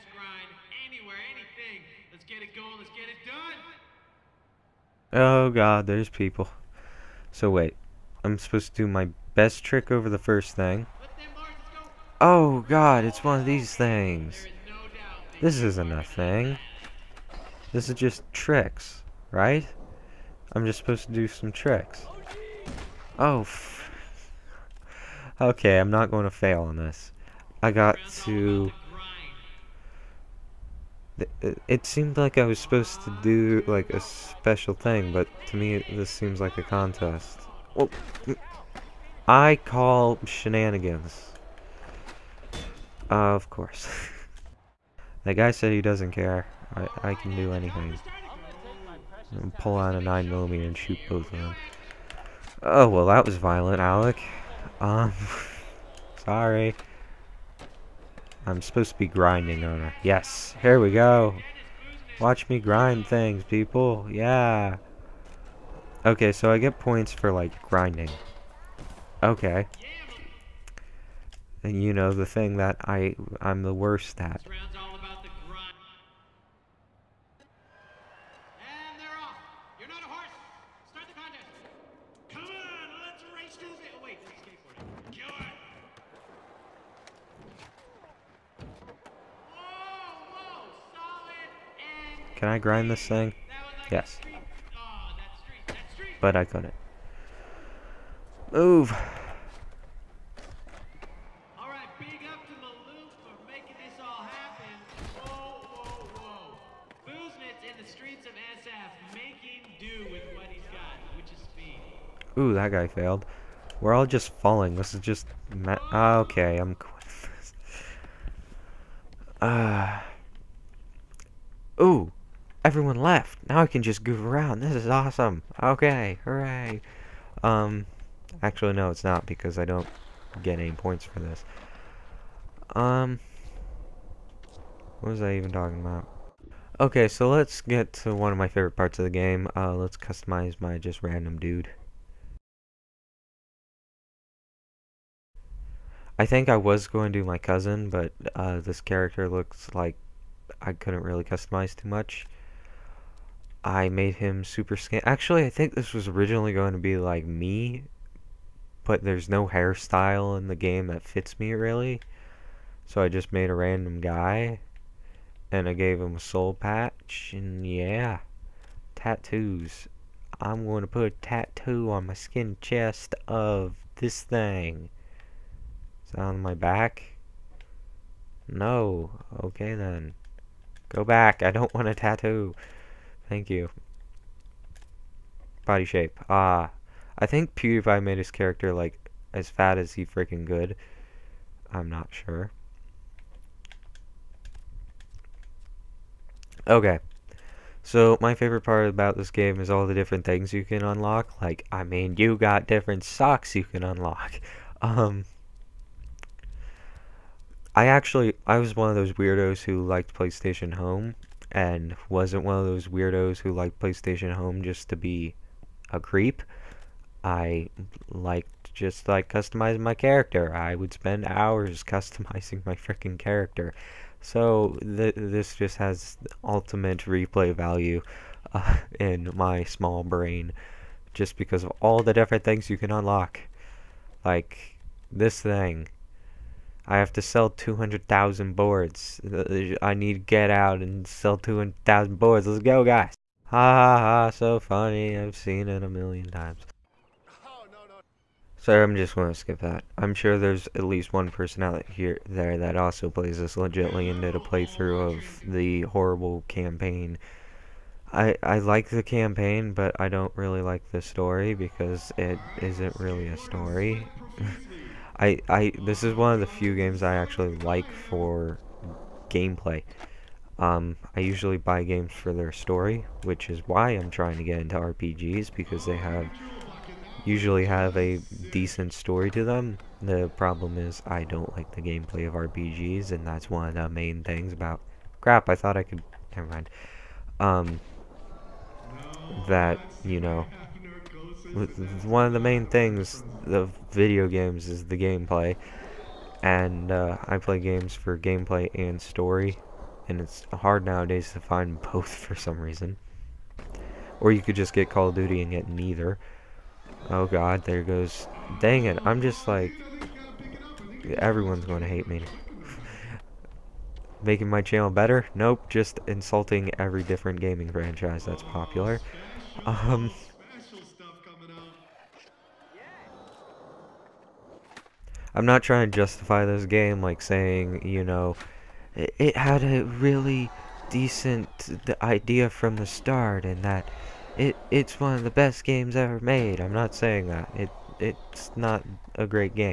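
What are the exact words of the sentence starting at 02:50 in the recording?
I'm going to put a tattoo on my skin chest of this thing on my back?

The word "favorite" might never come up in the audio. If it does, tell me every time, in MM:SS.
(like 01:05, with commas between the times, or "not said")
02:18, 03:18.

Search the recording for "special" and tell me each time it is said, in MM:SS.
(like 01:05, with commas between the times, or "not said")
00:33.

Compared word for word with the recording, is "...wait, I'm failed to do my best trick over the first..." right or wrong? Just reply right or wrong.
wrong.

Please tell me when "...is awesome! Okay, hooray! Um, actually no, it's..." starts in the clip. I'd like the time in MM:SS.
02:04.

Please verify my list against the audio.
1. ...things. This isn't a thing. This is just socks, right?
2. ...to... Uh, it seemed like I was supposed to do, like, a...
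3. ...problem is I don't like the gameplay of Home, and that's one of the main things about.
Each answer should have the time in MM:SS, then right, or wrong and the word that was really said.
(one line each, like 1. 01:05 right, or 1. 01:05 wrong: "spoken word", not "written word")
1. 00:13 wrong: "tricks", not "socks"
2. 00:28 right
3. 04:40 wrong: "RPGs", not "Home".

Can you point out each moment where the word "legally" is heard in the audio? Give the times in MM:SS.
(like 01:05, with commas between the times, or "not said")
not said.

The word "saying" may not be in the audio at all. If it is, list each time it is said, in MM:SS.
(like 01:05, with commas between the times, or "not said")
05:27, 05:36.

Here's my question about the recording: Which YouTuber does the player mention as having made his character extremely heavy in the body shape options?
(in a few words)
PewDiePie.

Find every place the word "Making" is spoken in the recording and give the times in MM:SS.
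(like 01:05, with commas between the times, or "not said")
05:14.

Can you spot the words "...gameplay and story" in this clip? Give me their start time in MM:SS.
04:58.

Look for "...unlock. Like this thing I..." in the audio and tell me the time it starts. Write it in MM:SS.
03:52.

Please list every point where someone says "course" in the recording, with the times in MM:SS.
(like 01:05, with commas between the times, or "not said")
00:43.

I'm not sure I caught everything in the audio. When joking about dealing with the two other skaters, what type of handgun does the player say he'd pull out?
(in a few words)
9mm.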